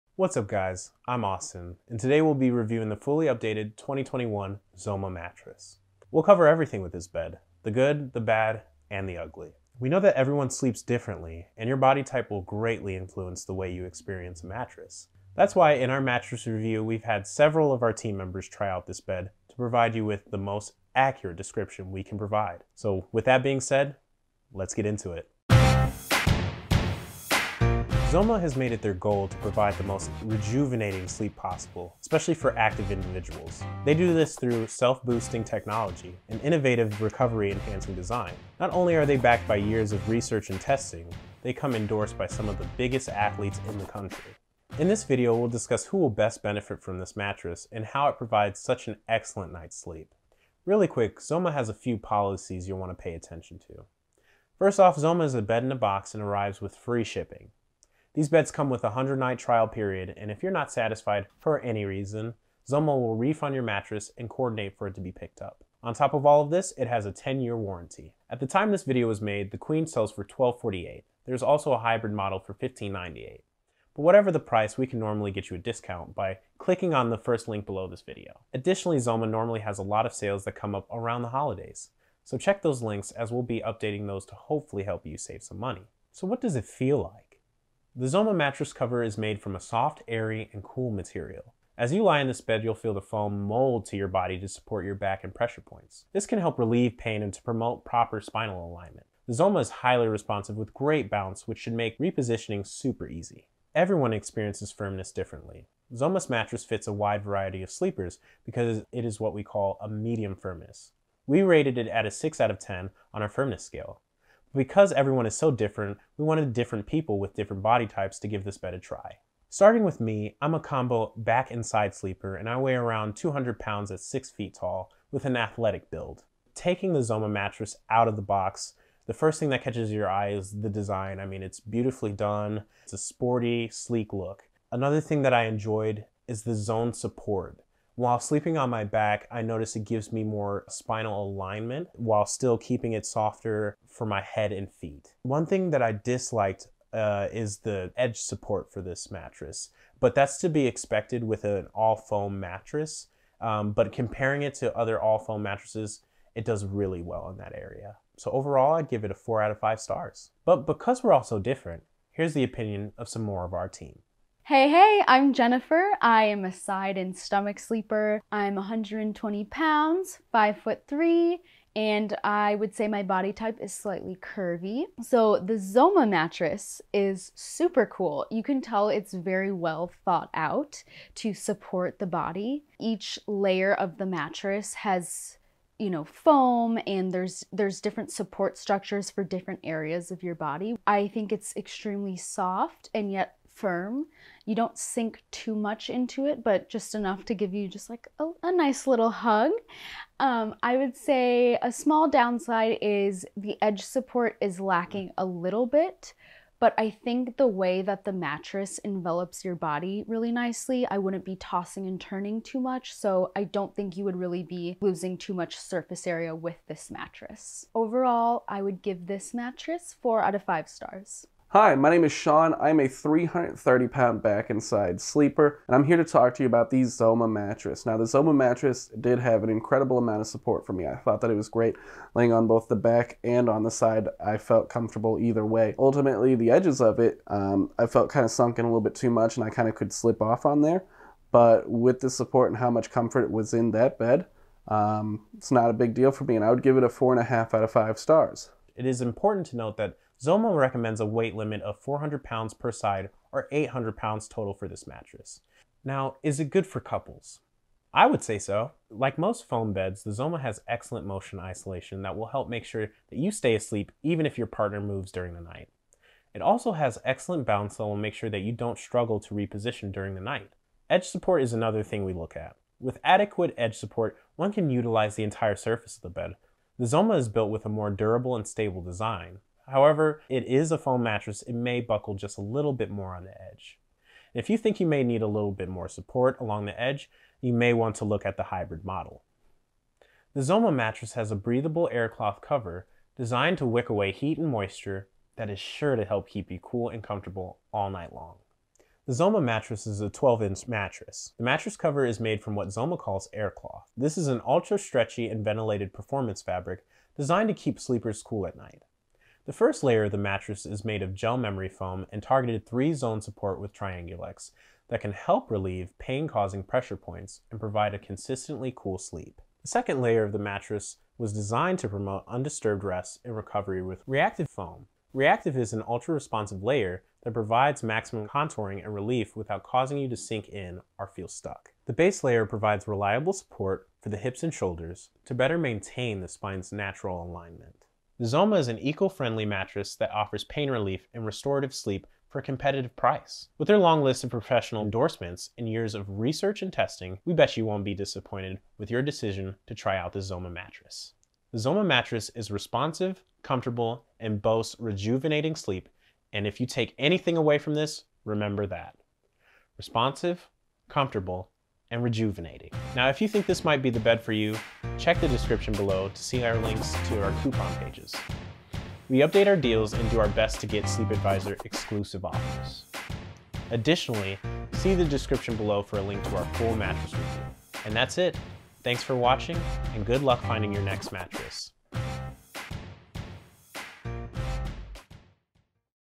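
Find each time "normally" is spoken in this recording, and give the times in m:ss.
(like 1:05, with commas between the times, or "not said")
1:14, 1:19.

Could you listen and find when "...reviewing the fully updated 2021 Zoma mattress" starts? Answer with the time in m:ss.
0:02.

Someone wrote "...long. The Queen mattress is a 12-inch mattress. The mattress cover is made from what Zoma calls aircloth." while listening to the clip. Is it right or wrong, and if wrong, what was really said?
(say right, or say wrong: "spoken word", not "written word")
wrong: "Zoma", not "Queen".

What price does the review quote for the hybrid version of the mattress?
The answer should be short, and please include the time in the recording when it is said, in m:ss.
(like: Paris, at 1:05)
$1598, at 1:12.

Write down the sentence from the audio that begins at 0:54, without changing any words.
First off, Zoma is a bed in a box and arrives with free shipping.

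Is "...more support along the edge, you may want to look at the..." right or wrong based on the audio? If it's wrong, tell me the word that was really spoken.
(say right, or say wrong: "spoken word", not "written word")
right.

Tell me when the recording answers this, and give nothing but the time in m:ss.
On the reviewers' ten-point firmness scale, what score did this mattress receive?
1:52.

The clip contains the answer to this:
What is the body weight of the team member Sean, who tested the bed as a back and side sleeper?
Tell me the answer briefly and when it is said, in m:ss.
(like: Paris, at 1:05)
330 pounds, at 3:42.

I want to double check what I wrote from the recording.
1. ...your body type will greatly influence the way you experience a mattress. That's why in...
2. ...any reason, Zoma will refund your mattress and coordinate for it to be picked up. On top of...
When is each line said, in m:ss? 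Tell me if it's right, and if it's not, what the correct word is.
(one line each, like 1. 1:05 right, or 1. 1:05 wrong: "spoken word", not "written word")
1. 0:11 right
2. 1:01 right.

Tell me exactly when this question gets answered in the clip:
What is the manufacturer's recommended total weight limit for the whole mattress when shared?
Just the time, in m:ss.
4:13.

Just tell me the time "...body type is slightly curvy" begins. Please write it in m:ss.
2:53.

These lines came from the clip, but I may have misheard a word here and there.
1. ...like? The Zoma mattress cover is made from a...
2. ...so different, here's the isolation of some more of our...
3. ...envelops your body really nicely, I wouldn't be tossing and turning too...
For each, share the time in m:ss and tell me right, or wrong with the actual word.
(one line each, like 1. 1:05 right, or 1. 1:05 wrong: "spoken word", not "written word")
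1. 1:27 right
2. 2:41 wrong: "opinion", not "isolation"
3. 3:28 right.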